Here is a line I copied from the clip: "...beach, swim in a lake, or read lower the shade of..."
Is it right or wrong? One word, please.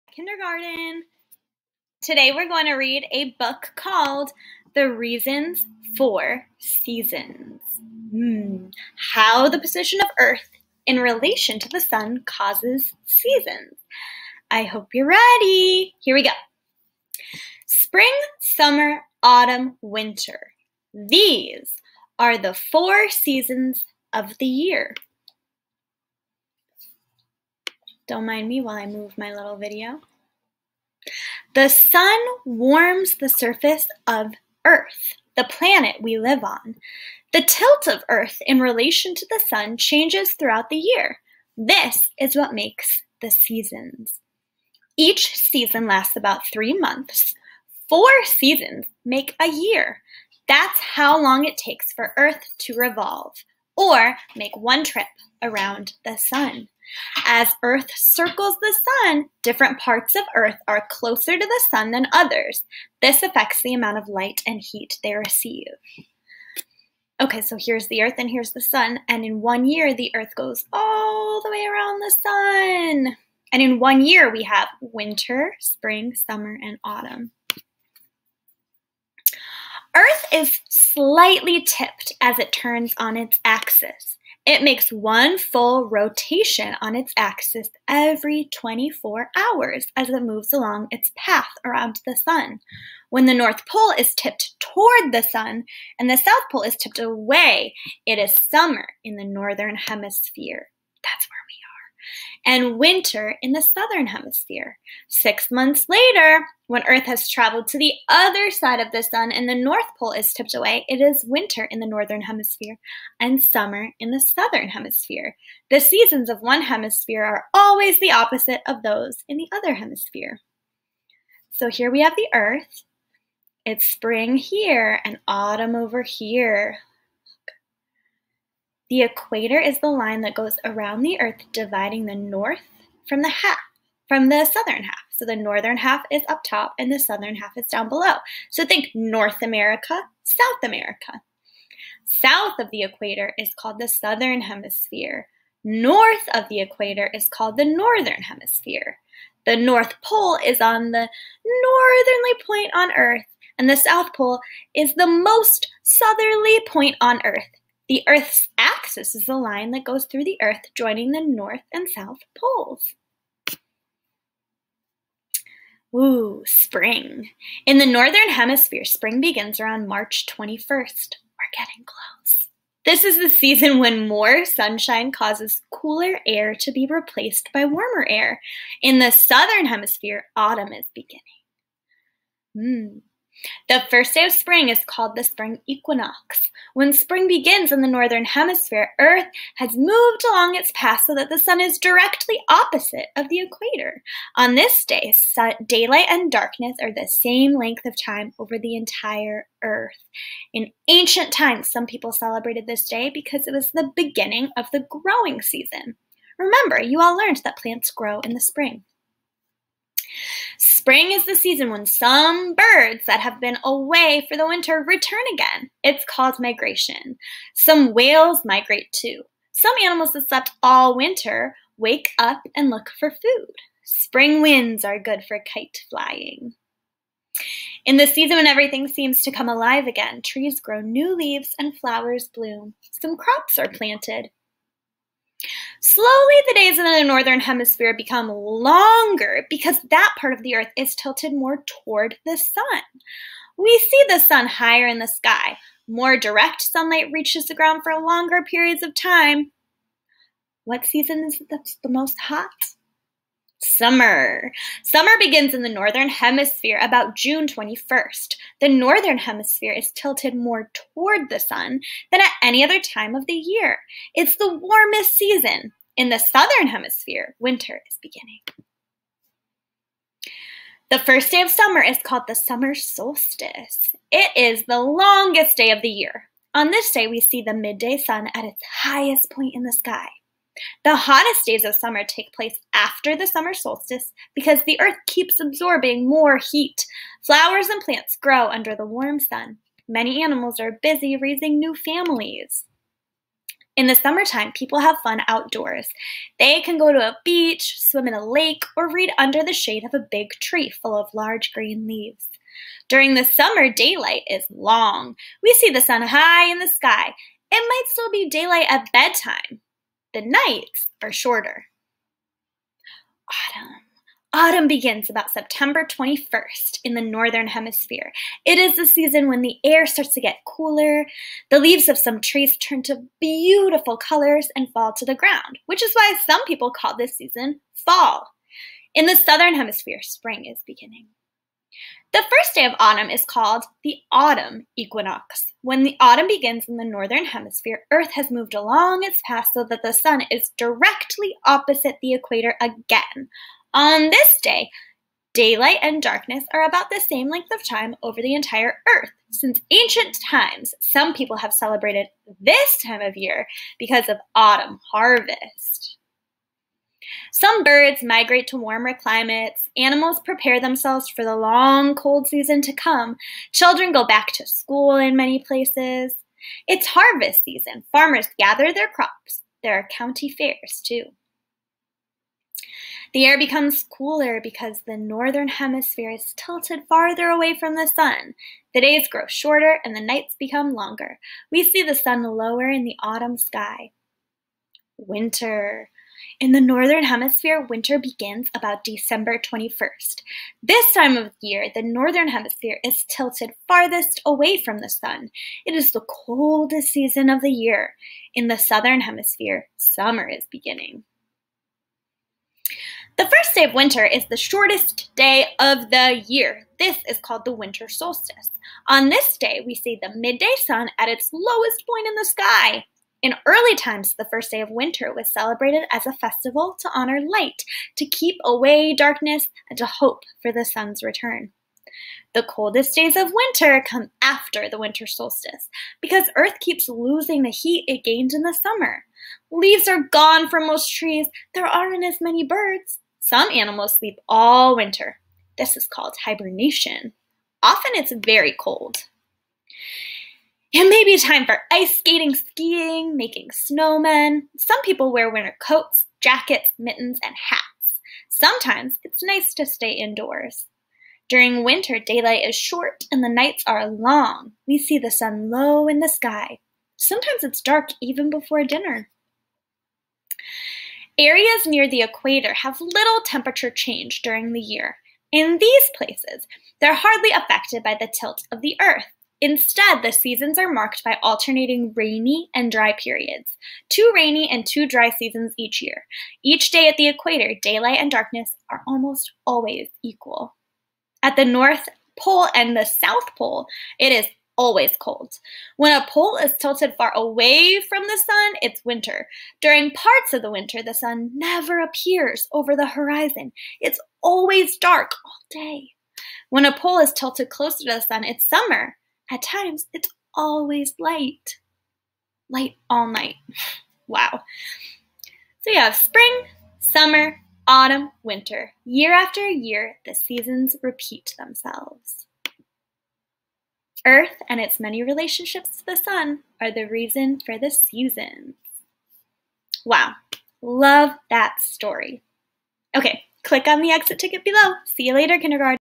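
wrong.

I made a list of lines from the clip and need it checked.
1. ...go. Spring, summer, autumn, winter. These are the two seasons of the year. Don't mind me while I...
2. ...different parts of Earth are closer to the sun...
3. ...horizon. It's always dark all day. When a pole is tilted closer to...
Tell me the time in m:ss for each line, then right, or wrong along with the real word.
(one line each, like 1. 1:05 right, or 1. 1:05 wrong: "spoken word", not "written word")
1. 0:16 wrong: "four", not "two"
2. 0:59 right
3. 8:12 right.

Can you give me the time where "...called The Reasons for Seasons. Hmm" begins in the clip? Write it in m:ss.
0:03.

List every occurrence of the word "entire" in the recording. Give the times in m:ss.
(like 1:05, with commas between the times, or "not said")
3:18, 5:48.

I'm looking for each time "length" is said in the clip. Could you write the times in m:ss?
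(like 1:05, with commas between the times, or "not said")
3:17, 5:47.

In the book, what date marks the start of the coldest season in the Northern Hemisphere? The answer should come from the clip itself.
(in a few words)
December 21st.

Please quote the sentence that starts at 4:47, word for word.
Flowers and plants grow under the warm sun.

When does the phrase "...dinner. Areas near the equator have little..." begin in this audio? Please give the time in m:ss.
7:38.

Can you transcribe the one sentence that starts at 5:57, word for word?
Some birds migrate to warmer climates.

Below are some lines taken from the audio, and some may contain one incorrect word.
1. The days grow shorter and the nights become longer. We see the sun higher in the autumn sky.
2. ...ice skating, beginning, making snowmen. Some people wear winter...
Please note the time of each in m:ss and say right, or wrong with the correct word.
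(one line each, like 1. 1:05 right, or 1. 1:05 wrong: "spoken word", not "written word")
1. 6:18 wrong: "lower", not "higher"
2. 7:21 wrong: "skiing", not "beginning".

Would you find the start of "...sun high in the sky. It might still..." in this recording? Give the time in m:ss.
5:05.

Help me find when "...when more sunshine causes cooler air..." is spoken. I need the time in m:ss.
2:53.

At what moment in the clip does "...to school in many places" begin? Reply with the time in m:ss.
6:04.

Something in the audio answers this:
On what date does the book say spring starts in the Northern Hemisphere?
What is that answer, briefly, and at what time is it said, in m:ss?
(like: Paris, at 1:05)
March 21st, at 2:49.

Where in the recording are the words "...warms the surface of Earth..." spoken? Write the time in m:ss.
0:32.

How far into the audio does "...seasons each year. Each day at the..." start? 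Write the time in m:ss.
7:55.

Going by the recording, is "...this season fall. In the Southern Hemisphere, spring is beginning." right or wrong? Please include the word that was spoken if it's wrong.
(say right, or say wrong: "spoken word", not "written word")
right.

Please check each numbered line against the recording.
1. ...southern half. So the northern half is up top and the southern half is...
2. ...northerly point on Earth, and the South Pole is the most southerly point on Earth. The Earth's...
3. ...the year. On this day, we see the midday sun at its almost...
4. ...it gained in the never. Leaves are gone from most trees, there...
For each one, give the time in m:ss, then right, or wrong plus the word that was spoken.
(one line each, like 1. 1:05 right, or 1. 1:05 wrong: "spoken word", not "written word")
1. 2:14 right
2. 2:31 right
3. 4:35 wrong: "highest", not "almost"
4. 7:07 wrong: "summer", not "never".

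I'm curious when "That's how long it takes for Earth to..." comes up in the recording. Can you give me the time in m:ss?
0:50.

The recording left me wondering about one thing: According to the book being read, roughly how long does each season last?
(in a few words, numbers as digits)
3 months.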